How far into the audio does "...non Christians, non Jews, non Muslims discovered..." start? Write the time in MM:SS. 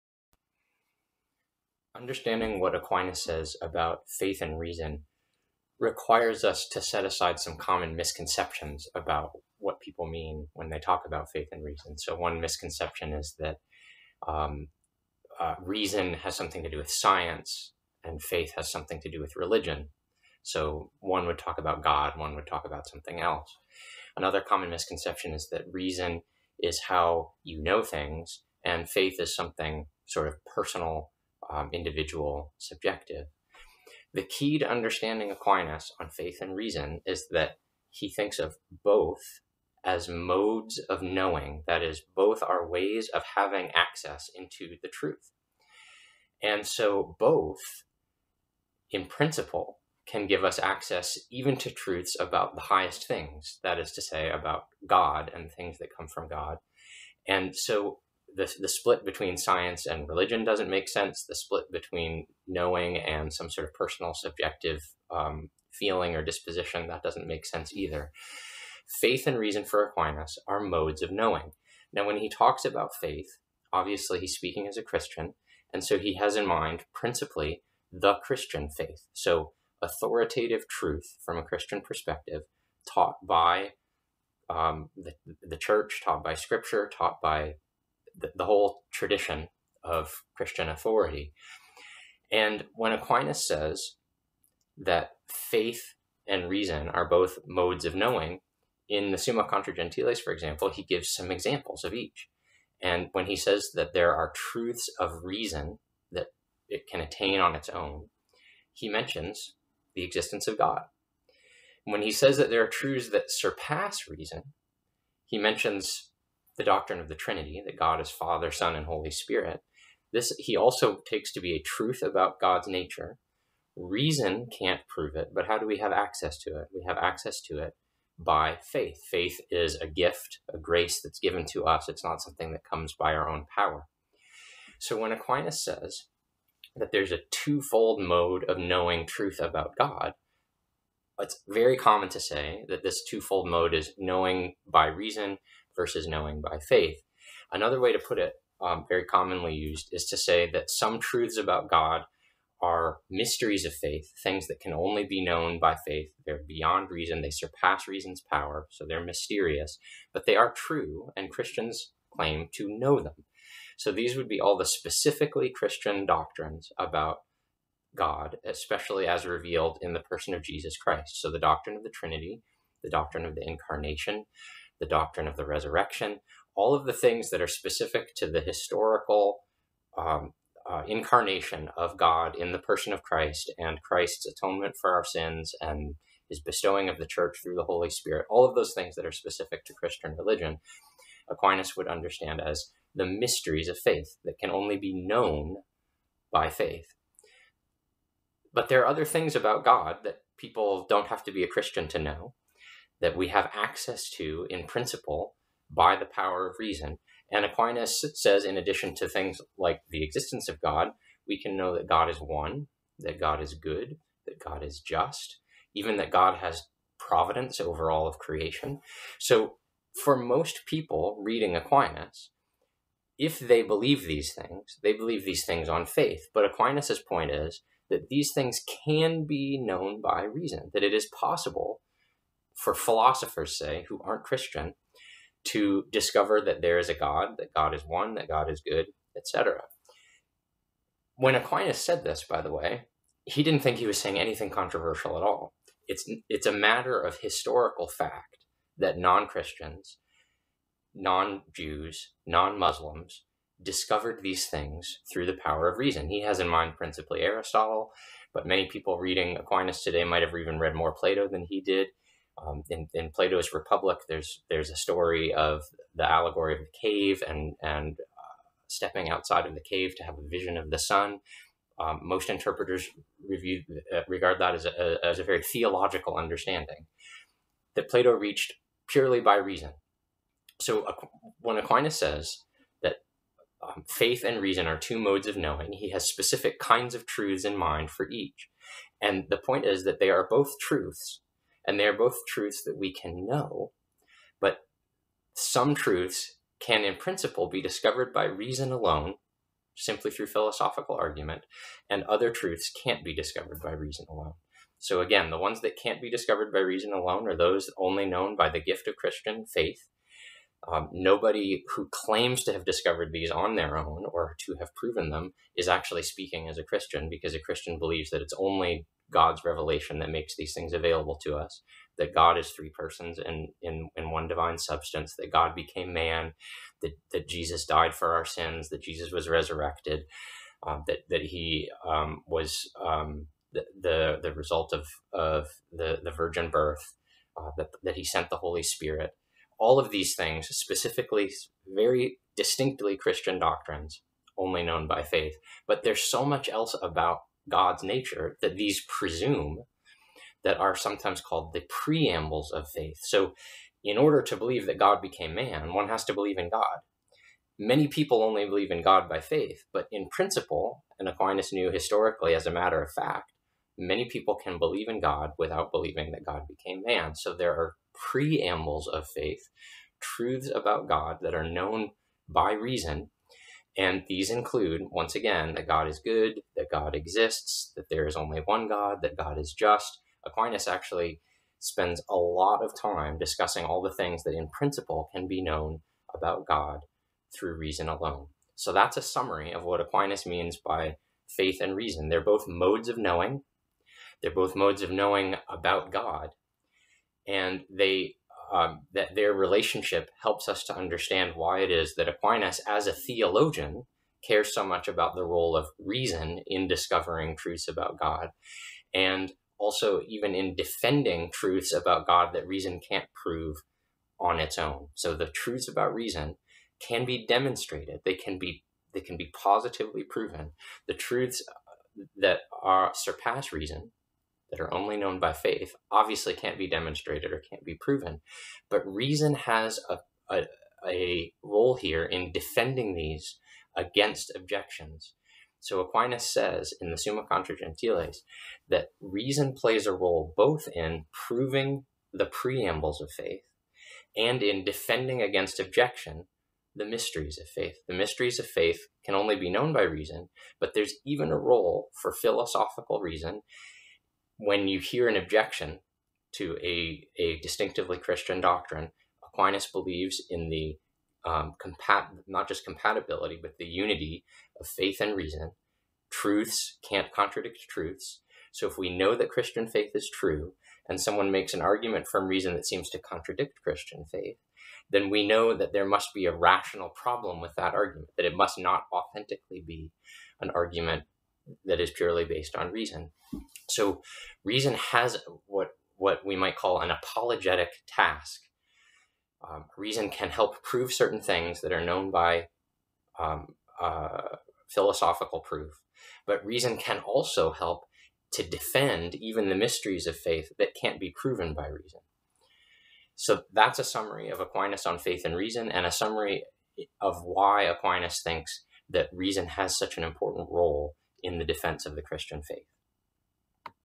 04:08.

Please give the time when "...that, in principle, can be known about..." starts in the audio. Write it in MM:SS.
06:24.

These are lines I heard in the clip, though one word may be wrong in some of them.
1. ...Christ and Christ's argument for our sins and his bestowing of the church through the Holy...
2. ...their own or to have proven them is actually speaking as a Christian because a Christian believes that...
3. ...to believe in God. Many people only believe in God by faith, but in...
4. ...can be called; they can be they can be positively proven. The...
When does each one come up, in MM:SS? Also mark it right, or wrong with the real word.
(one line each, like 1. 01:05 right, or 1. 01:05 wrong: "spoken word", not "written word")
1. 03:03 wrong: "atonement", not "argument"
2. 05:13 right
3. 05:56 right
4. 06:56 wrong: "demonstrated", not "called".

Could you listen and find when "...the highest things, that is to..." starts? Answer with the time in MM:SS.
00:52.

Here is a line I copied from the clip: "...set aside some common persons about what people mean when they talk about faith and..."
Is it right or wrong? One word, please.
wrong.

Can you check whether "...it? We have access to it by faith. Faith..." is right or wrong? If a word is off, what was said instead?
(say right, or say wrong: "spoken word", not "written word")
right.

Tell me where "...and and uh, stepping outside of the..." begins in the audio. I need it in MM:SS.
04:27.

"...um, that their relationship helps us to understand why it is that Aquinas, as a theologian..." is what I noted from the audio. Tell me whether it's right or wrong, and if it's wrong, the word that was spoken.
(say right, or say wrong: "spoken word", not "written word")
right.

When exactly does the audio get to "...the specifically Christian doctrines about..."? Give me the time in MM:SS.
02:44.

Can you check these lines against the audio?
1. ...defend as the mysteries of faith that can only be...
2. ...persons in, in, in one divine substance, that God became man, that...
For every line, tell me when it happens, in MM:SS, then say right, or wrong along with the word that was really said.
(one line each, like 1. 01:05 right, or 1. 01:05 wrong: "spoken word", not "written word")
1. 03:11 wrong: "understand", not "defend"
2. 05:22 right.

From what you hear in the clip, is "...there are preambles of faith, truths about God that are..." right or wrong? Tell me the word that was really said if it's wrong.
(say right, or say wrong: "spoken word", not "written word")
right.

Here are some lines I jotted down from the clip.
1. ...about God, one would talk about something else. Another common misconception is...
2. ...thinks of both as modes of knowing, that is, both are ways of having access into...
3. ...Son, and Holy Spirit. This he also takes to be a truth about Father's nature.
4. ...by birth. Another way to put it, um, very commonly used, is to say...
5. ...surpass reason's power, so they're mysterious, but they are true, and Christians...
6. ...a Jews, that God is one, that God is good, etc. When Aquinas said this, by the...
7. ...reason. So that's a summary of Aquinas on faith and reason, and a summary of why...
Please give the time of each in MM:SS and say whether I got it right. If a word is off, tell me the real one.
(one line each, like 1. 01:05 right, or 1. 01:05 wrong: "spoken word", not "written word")
1. 00:21 right
2. 00:38 right
3. 01:58 wrong: "God", not "Father"
4. 02:26 wrong: "faith", not "birth"
5. 02:37 right
6. 03:56 wrong: "God", not "Jews"
7. 08:21 right.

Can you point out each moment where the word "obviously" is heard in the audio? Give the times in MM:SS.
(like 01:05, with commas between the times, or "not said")
01:13, 07:05.